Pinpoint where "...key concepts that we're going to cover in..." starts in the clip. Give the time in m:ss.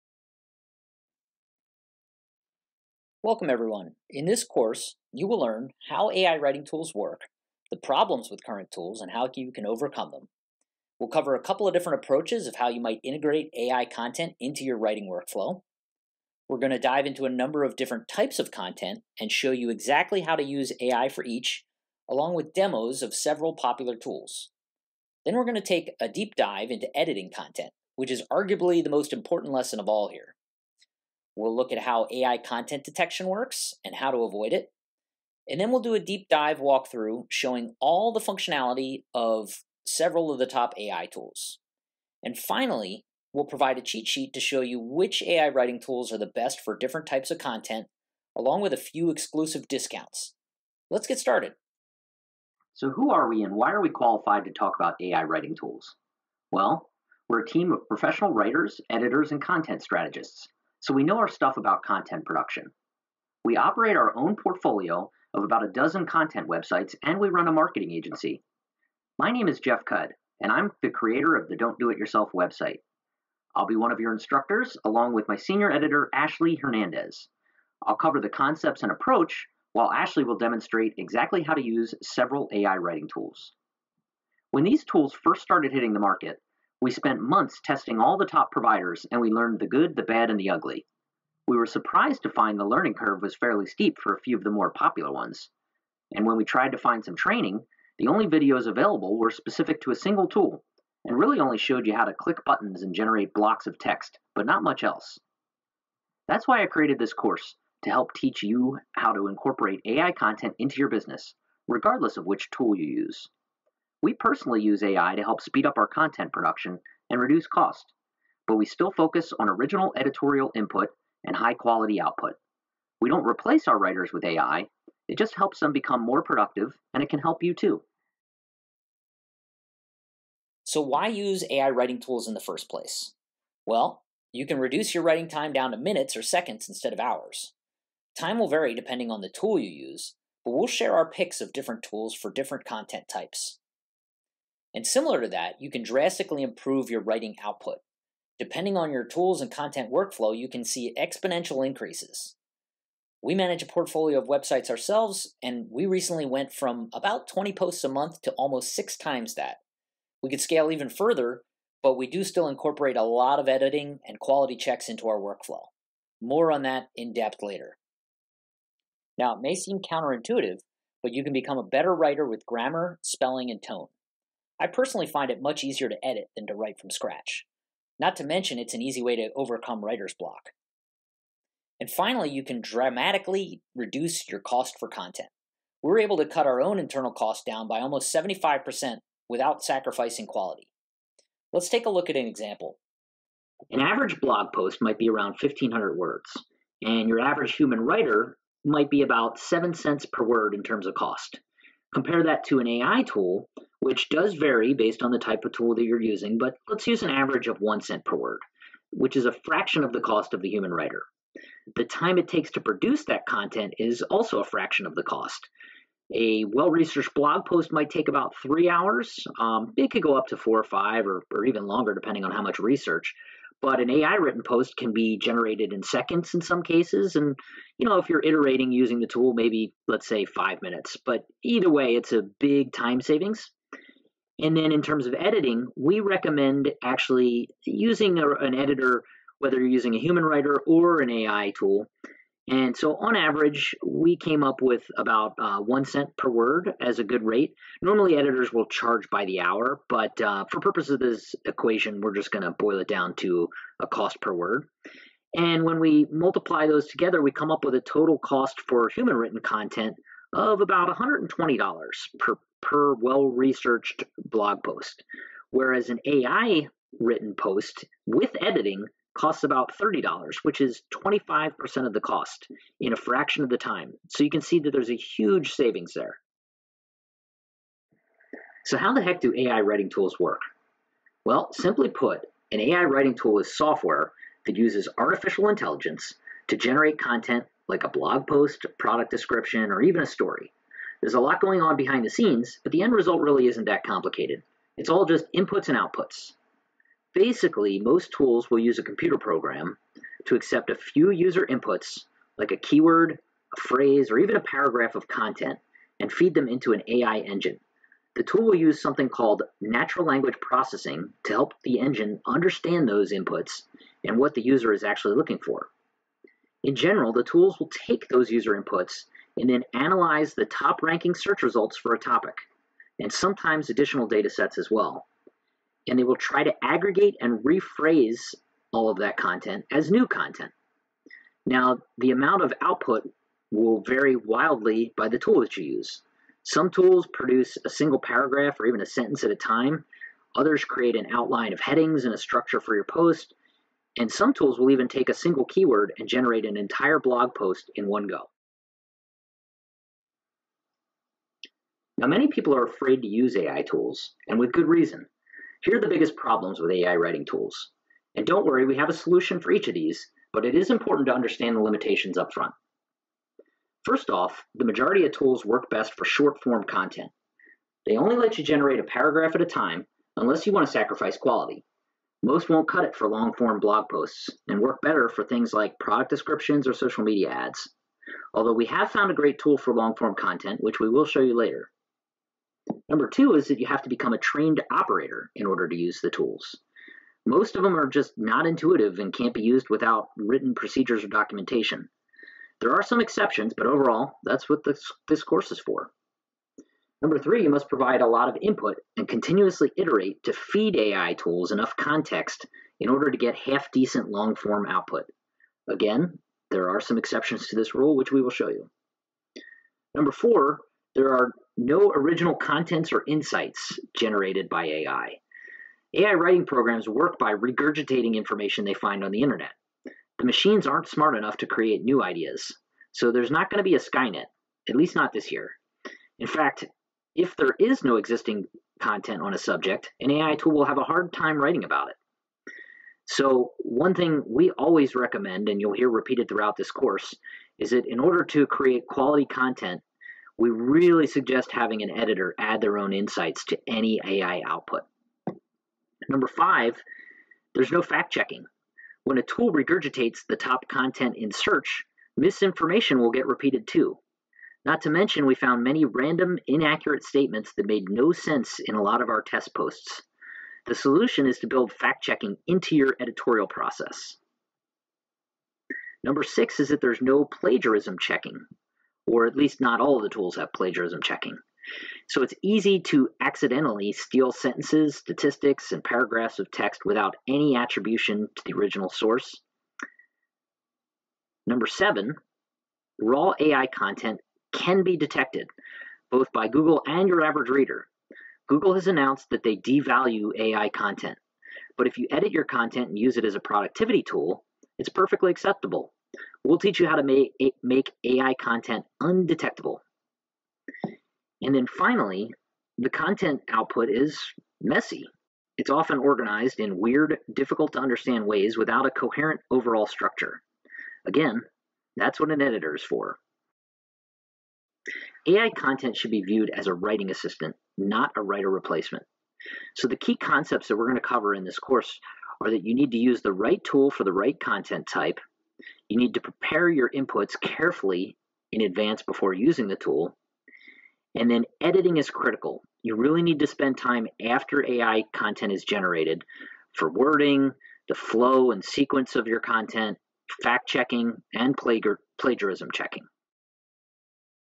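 8:39.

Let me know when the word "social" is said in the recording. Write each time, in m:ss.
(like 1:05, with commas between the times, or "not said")
6:16.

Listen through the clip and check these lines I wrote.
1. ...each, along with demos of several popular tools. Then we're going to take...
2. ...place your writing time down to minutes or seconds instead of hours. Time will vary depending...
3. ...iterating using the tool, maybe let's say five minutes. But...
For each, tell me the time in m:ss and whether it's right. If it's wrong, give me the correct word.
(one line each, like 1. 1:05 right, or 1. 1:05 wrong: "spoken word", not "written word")
1. 0:21 right
2. 2:14 wrong: "reduce", not "place"
3. 3:48 right.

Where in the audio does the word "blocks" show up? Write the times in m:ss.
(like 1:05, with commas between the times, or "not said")
1:43, 3:00.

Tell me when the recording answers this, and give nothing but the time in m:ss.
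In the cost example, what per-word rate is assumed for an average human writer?
3:19.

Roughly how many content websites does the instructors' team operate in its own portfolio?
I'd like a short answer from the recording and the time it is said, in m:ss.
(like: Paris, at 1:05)
about a dozen, at 1:05.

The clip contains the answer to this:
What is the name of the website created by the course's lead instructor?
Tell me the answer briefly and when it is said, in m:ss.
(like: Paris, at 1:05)
Don't Do It Yourself, at 1:11.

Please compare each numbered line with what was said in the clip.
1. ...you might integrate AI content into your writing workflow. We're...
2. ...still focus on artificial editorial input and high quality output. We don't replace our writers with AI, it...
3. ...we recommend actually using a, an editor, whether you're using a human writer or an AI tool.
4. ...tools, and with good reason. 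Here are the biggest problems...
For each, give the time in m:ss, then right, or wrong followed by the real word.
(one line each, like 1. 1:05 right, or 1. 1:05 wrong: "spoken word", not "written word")
1. 0:12 right
2. 1:58 wrong: "original", not "artificial"
3. 3:55 right
4. 5:53 right.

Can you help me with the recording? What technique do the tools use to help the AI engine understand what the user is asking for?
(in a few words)
natural language processing.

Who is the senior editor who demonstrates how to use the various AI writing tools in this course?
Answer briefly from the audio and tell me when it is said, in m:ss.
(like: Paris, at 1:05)
Ashley Hernandez, at 1:16.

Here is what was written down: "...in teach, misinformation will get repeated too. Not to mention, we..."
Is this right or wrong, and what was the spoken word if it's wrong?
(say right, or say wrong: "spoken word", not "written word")
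wrong: "search", not "teach".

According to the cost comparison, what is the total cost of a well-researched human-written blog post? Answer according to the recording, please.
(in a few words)
$120.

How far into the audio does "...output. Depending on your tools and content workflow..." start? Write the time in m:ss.
2:27.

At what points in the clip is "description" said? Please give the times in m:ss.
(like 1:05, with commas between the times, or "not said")
4:49, 6:16.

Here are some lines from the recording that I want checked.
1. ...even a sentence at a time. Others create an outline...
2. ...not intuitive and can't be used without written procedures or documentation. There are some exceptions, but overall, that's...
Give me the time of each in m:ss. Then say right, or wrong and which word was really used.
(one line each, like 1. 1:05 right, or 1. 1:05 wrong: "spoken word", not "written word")
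1. 5:38 right
2. 6:28 right.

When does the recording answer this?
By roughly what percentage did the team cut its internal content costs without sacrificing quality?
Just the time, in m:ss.
3:08.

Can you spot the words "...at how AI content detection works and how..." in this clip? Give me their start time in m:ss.
0:31.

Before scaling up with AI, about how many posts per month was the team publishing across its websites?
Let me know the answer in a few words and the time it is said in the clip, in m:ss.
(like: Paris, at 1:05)
20, at 2:37.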